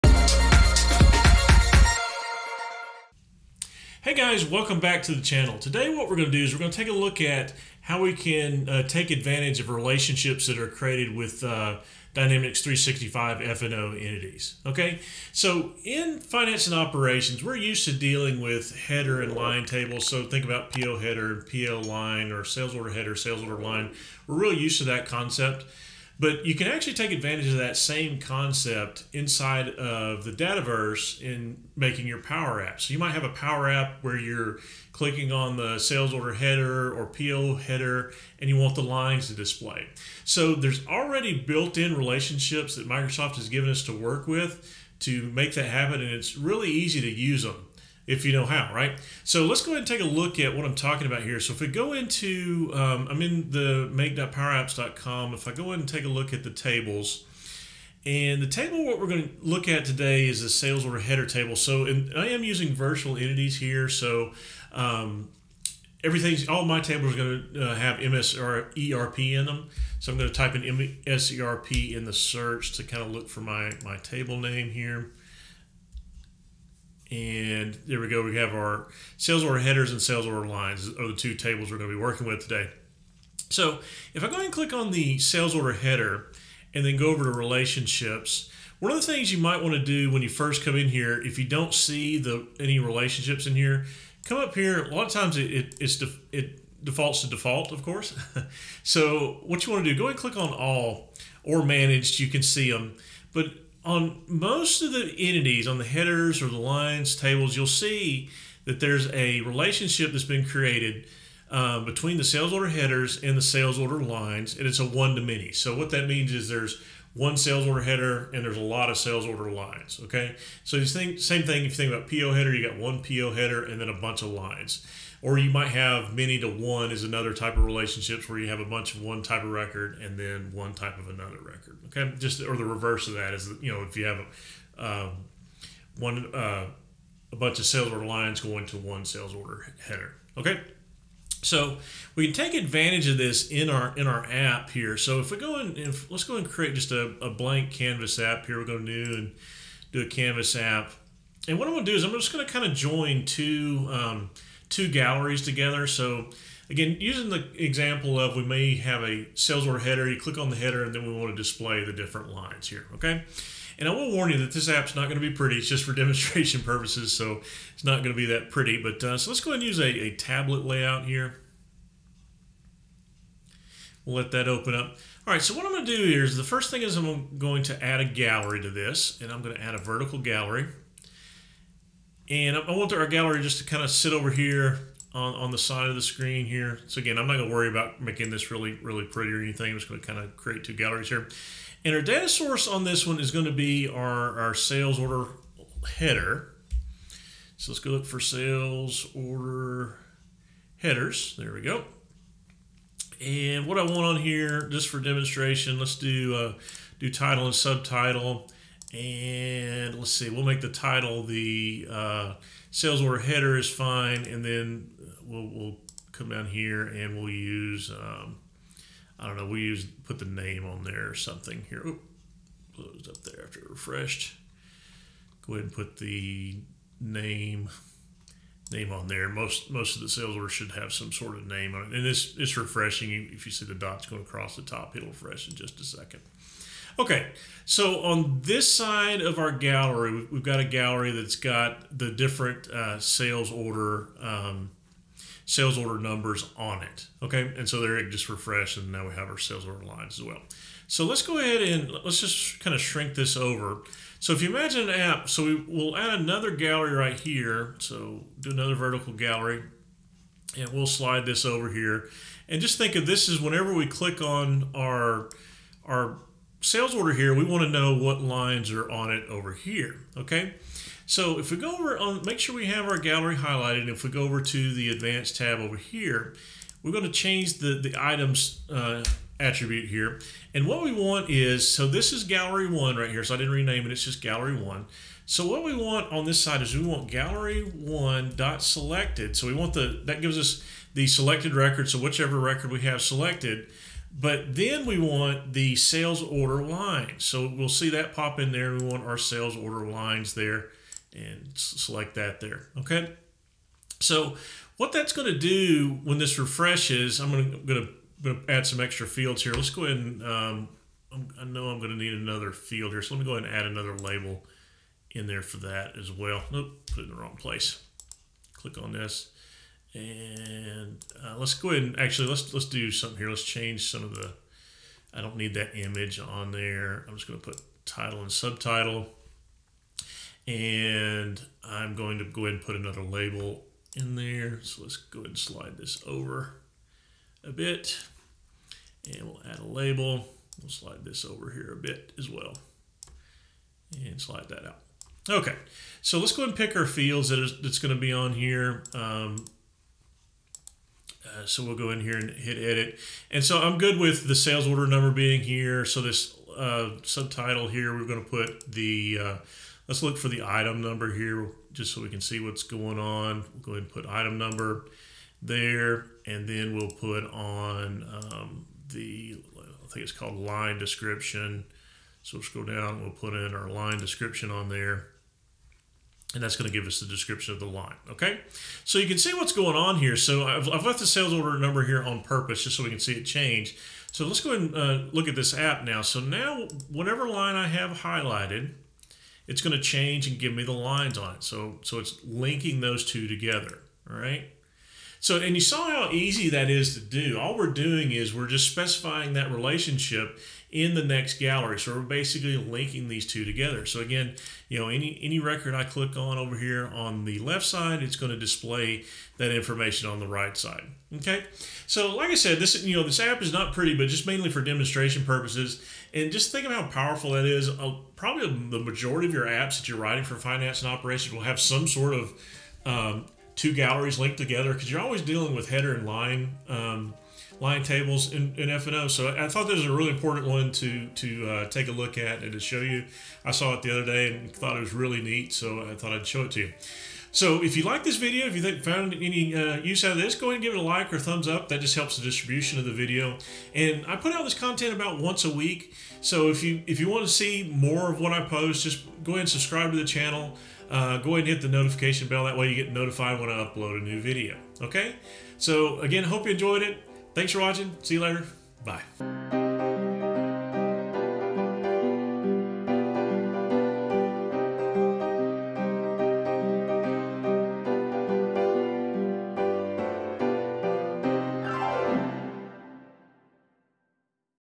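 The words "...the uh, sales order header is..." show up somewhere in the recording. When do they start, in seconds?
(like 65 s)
211 s.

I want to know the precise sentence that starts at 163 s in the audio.
And I will warn you that this app's not going to be pretty.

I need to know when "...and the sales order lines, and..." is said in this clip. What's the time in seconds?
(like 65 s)
113 s.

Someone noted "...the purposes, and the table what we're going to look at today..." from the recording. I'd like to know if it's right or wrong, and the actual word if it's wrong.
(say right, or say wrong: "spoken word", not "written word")
wrong: "tables", not "purposes".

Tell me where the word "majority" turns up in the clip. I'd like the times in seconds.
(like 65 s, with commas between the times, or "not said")
418 s.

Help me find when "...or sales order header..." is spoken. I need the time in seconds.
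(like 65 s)
22 s.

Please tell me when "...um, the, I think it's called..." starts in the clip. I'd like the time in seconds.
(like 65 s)
368 s.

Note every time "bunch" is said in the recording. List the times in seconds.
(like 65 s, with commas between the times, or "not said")
123 s, 128 s, 137 s.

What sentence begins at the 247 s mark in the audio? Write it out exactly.
Okay, and so there it just refreshed, and now we have our sales order lines as well.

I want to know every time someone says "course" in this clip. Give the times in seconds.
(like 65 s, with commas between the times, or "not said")
97 s.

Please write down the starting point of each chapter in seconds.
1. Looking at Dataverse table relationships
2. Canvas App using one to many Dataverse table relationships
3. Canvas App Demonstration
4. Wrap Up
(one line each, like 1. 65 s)
1. 51 s
2. 146 s
3. 380 s
4. 413 s.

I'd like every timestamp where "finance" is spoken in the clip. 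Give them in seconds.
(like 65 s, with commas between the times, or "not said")
16 s, 420 s.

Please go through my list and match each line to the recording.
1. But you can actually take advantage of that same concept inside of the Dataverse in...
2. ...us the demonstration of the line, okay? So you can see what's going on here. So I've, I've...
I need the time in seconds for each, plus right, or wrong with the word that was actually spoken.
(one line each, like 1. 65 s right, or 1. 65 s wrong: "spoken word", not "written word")
1. 26 s right
2. 376 s wrong: "description", not "demonstration".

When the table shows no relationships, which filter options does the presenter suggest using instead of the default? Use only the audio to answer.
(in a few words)
all or managed.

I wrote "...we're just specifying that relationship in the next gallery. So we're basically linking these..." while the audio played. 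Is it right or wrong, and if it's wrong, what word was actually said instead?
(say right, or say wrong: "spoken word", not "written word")
right.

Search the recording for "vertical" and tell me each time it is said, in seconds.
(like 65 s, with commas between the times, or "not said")
179 s, 258 s.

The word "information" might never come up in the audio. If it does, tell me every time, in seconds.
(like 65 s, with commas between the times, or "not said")
409 s.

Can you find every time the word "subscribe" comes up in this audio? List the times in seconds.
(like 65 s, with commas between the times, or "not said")
449 s.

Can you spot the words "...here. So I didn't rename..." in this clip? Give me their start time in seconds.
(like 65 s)
283 s.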